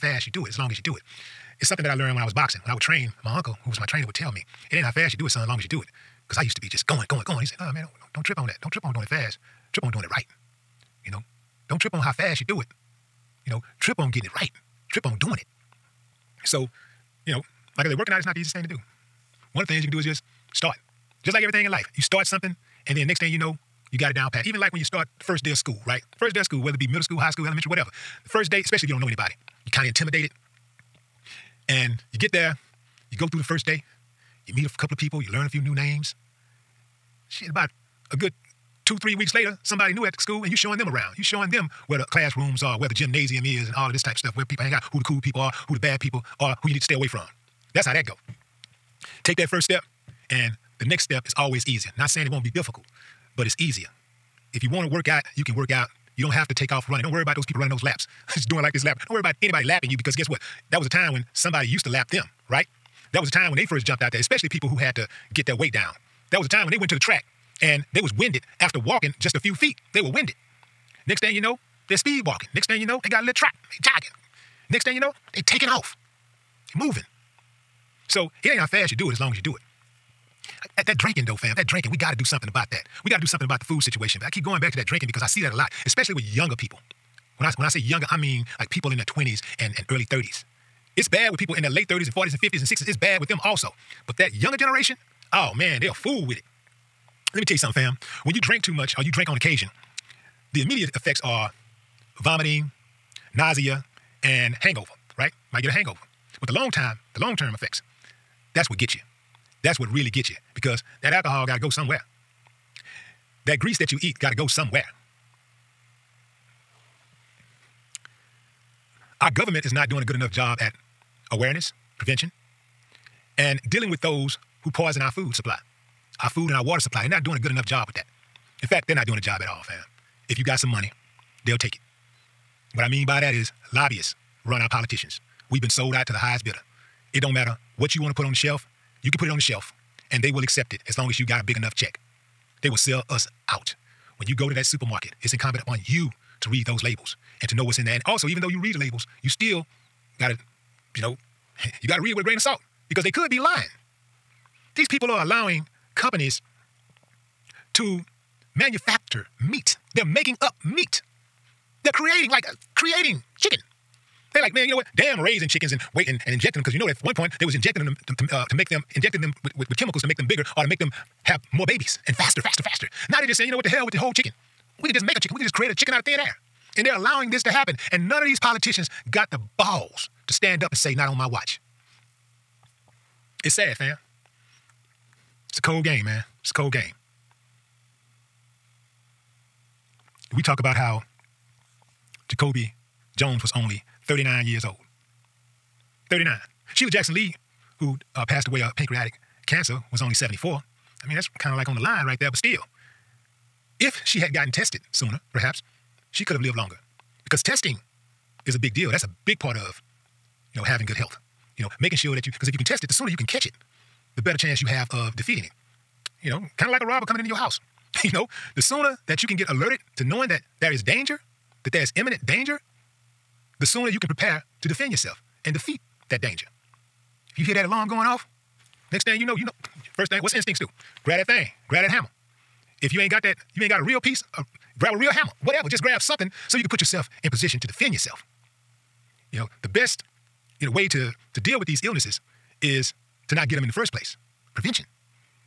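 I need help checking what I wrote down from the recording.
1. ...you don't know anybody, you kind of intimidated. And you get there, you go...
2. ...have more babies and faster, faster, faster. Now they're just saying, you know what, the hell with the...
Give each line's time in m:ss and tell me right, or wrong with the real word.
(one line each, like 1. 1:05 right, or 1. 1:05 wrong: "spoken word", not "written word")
1. 0:28 right
2. 2:51 right.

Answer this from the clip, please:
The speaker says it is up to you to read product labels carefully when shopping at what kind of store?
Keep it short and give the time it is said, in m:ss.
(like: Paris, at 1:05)
Supermarket, at 2:24.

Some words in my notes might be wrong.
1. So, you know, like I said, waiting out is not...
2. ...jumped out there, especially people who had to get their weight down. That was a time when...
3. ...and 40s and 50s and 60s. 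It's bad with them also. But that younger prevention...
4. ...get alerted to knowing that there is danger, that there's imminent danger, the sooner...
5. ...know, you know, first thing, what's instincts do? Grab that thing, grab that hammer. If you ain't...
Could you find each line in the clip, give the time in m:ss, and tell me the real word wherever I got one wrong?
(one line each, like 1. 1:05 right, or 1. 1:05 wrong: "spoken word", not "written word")
1. 0:16 wrong: "working", not "waiting"
2. 1:03 right
3. 1:32 wrong: "generation", not "prevention"
4. 3:39 right
5. 3:49 right.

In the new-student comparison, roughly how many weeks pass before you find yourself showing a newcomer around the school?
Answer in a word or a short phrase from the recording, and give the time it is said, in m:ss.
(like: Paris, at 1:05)
2, 3 weeks, at 0:38.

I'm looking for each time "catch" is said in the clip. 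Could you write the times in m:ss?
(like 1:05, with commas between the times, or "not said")
3:33.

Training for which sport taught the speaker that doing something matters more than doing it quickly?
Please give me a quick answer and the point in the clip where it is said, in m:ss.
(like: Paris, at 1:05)
Boxing, at 0:02.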